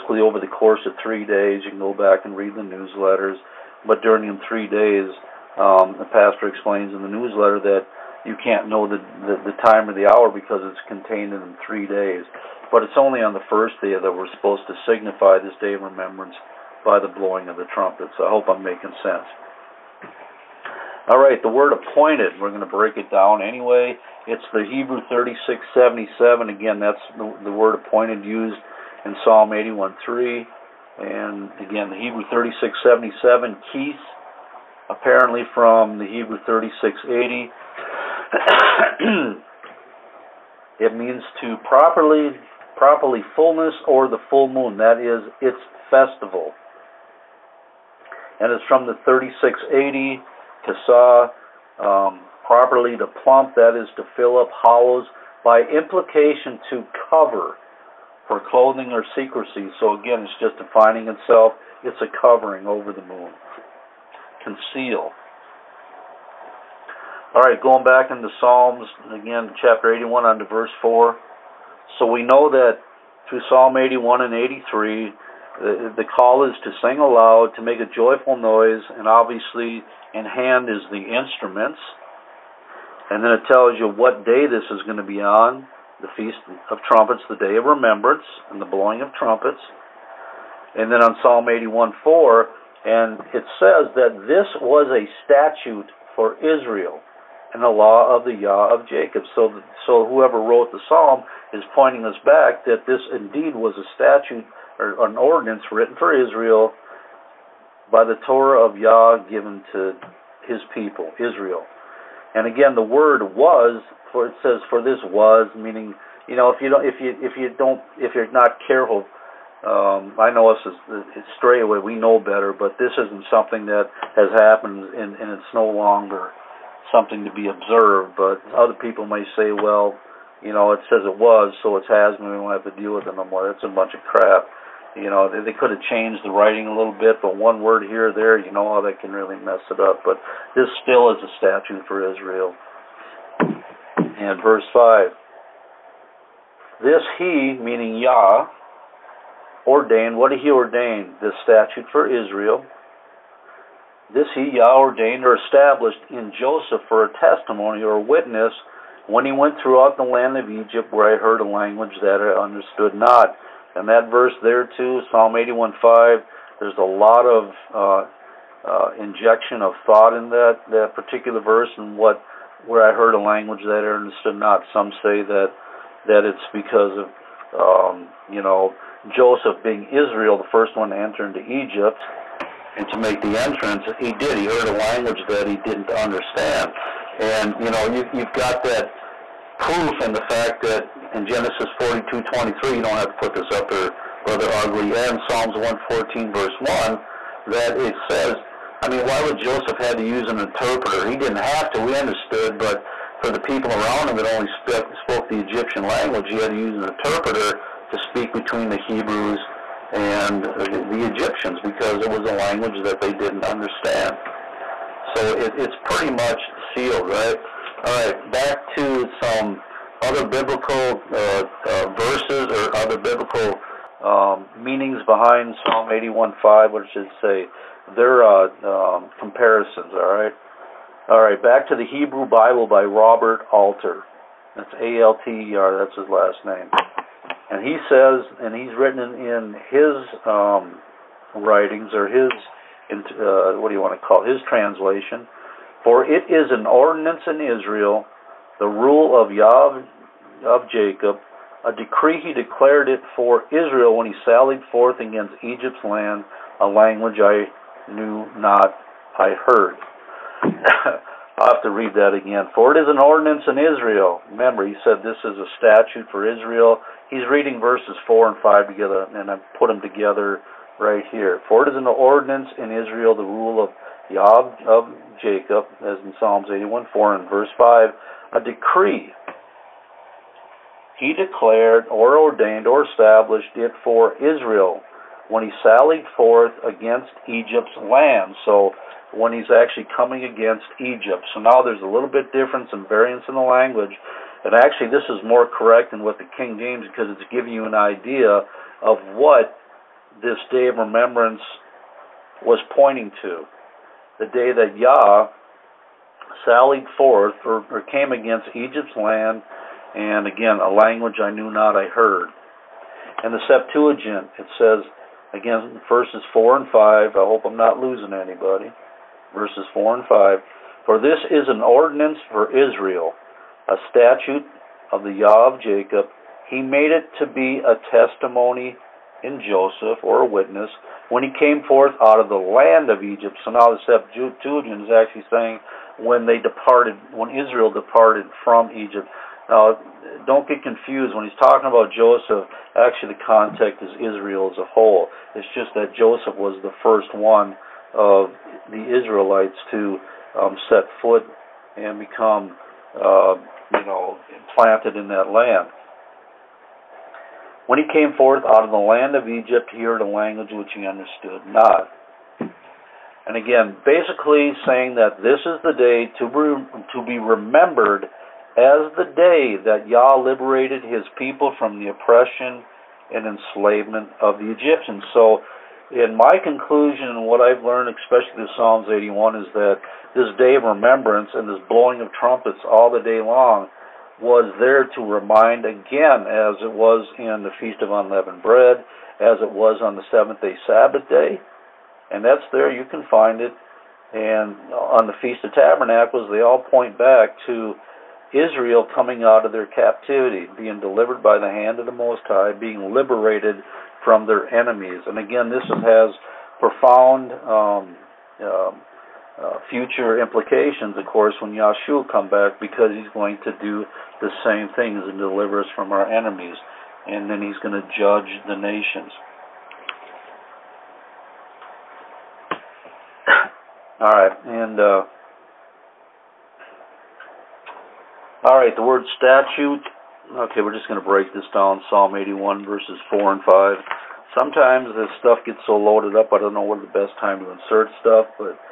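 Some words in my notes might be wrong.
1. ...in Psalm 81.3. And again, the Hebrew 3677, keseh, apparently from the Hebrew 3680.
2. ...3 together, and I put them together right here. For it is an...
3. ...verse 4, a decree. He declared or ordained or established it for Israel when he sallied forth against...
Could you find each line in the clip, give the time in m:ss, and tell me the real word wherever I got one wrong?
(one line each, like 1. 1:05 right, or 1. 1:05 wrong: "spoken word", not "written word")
1. 0:29 right
2. 4:28 wrong: "5", not "3"
3. 4:37 wrong: "5", not "4".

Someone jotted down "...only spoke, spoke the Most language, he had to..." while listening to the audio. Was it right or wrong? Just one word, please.
wrong.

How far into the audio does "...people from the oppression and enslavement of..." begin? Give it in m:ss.
6:11.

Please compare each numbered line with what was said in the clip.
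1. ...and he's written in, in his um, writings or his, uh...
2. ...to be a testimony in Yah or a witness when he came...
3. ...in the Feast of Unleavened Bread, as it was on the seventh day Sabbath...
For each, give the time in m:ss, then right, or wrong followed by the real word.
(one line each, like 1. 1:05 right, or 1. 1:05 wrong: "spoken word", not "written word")
1. 3:58 right
2. 5:27 wrong: "Joseph", not "Yah"
3. 6:27 right.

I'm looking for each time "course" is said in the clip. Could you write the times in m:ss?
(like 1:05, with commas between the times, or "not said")
0:00, 6:51.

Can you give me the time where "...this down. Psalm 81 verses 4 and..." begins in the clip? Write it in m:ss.
7:11.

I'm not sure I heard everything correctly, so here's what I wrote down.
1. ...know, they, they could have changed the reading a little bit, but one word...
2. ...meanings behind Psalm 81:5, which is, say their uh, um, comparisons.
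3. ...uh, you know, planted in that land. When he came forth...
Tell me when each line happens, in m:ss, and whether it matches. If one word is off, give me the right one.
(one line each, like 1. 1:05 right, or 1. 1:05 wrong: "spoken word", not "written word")
1. 2:15 wrong: "writing", not "reading"
2. 3:44 right
3. 5:52 right.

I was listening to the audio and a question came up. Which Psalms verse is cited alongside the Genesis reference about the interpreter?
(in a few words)
Psalms 114:1.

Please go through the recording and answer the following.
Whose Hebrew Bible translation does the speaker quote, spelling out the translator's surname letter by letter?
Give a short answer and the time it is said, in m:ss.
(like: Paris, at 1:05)
Robert Alter, at 3:52.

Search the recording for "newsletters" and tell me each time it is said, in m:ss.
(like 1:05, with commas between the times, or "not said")
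0:02, 0:07.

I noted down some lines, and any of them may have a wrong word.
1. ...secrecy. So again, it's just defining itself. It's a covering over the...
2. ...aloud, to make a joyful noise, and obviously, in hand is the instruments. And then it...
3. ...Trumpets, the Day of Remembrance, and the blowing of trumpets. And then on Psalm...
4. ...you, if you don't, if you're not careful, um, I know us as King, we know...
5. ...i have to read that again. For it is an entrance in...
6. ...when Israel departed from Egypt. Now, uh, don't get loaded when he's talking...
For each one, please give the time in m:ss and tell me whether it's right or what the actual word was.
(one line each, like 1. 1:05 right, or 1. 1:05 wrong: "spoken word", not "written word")
1. 0:59 right
2. 1:16 right
3. 1:26 right
4. 1:57 wrong: "Straitway", not "King"
5. 4:21 wrong: "ordinance", not "entrance"
6. 5:37 wrong: "confused", not "loaded".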